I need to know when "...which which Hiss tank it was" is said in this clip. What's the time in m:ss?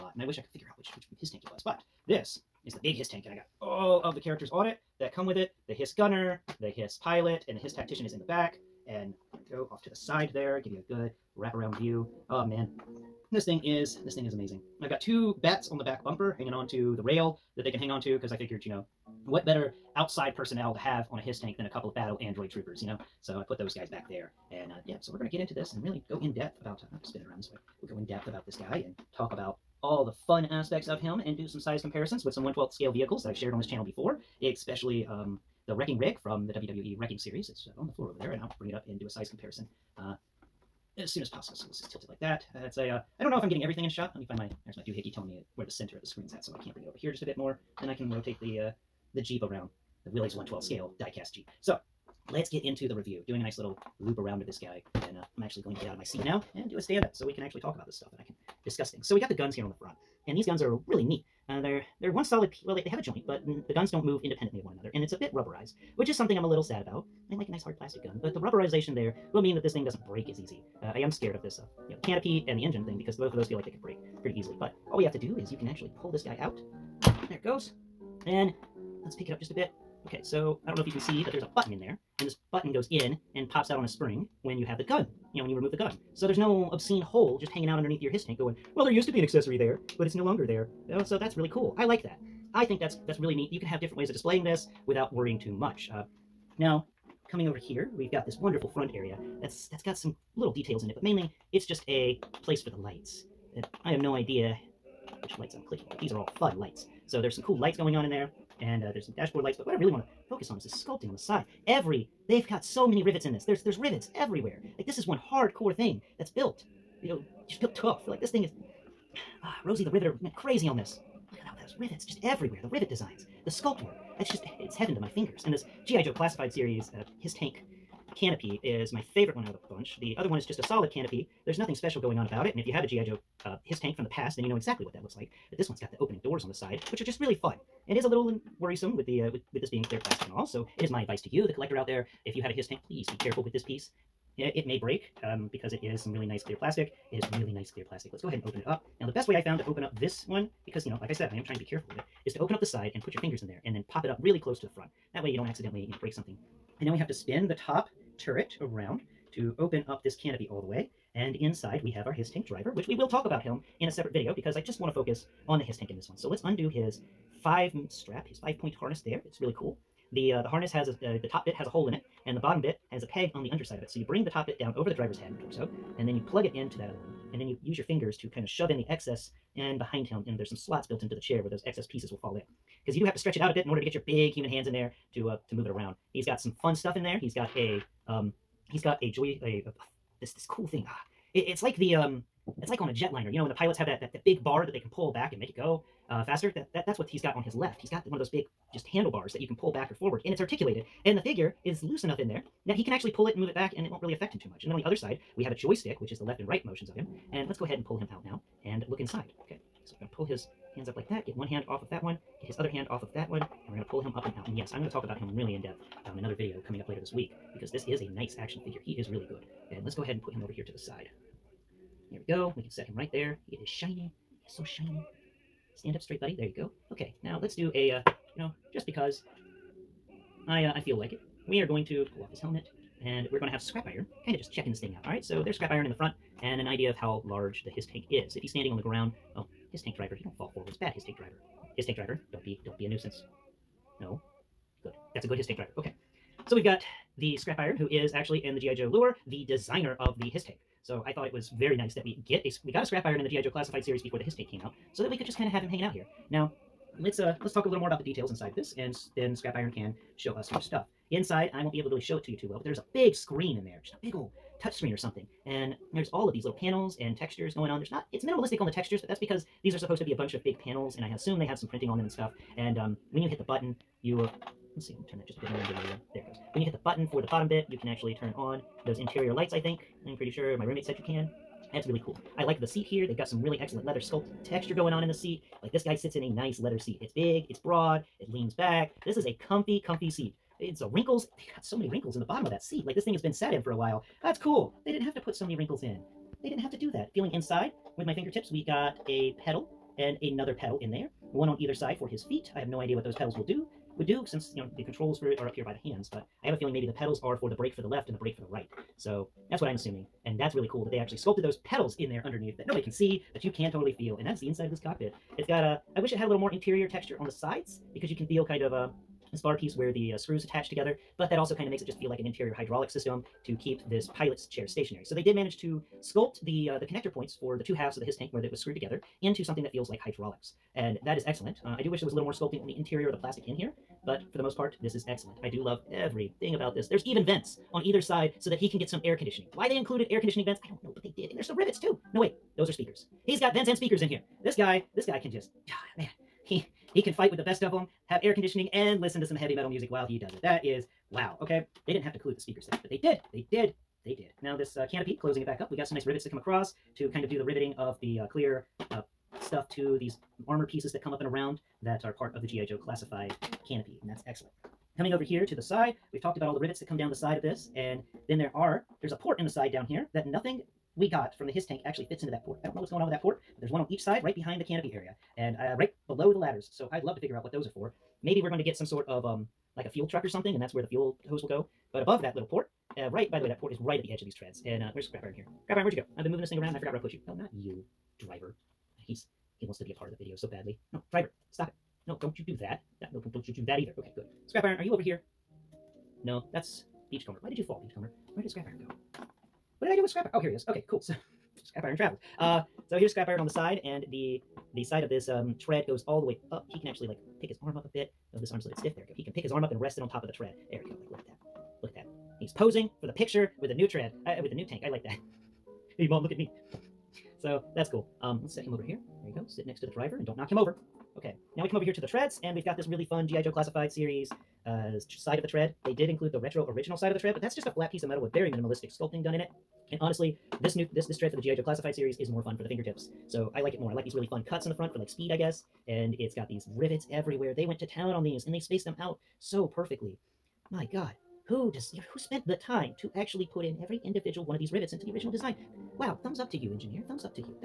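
0:00.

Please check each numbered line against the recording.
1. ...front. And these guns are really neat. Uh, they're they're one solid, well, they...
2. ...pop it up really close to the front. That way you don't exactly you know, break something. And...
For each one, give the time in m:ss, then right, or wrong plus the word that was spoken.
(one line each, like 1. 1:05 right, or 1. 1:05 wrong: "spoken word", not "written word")
1. 0:59 right
2. 2:33 wrong: "accidentally", not "exactly".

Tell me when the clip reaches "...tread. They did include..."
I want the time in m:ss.
7:05.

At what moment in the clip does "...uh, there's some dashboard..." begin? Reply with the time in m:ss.
1:48.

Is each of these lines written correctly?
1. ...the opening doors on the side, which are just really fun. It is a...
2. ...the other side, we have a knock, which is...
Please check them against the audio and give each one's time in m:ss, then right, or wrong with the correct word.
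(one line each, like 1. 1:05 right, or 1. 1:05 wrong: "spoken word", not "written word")
1. 2:15 right
2. 3:24 wrong: "joystick", not "knock".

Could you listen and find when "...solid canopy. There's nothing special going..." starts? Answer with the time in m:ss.
2:10.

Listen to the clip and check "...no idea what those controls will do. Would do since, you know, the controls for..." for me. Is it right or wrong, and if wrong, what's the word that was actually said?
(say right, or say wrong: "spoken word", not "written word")
wrong: "pedals", not "controls".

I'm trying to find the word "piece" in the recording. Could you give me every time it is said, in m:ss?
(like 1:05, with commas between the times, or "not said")
2:23, 3:01, 5:19, 6:00, 7:07.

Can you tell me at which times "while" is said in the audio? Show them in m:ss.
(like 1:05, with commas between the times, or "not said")
4:53, 5:49.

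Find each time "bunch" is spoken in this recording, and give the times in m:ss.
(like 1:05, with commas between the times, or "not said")
2:09, 4:30.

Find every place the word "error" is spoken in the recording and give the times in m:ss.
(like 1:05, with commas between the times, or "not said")
not said.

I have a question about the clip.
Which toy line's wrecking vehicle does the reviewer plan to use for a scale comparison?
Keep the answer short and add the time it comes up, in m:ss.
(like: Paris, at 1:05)
WWE Wrecking Series, at 0:36.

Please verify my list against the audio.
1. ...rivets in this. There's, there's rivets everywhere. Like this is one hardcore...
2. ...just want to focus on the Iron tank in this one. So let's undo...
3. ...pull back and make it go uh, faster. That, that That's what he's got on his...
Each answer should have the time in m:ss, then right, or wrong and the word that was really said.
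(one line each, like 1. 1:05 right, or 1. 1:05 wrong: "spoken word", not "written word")
1. 1:53 right
2. 2:44 wrong: "Hiss", not "Iron"
3. 3:14 right.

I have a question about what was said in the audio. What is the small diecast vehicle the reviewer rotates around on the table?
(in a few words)
Willys.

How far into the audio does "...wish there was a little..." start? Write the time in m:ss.
5:31.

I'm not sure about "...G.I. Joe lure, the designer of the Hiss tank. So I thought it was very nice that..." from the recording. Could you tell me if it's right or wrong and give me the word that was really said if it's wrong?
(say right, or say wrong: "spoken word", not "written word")
right.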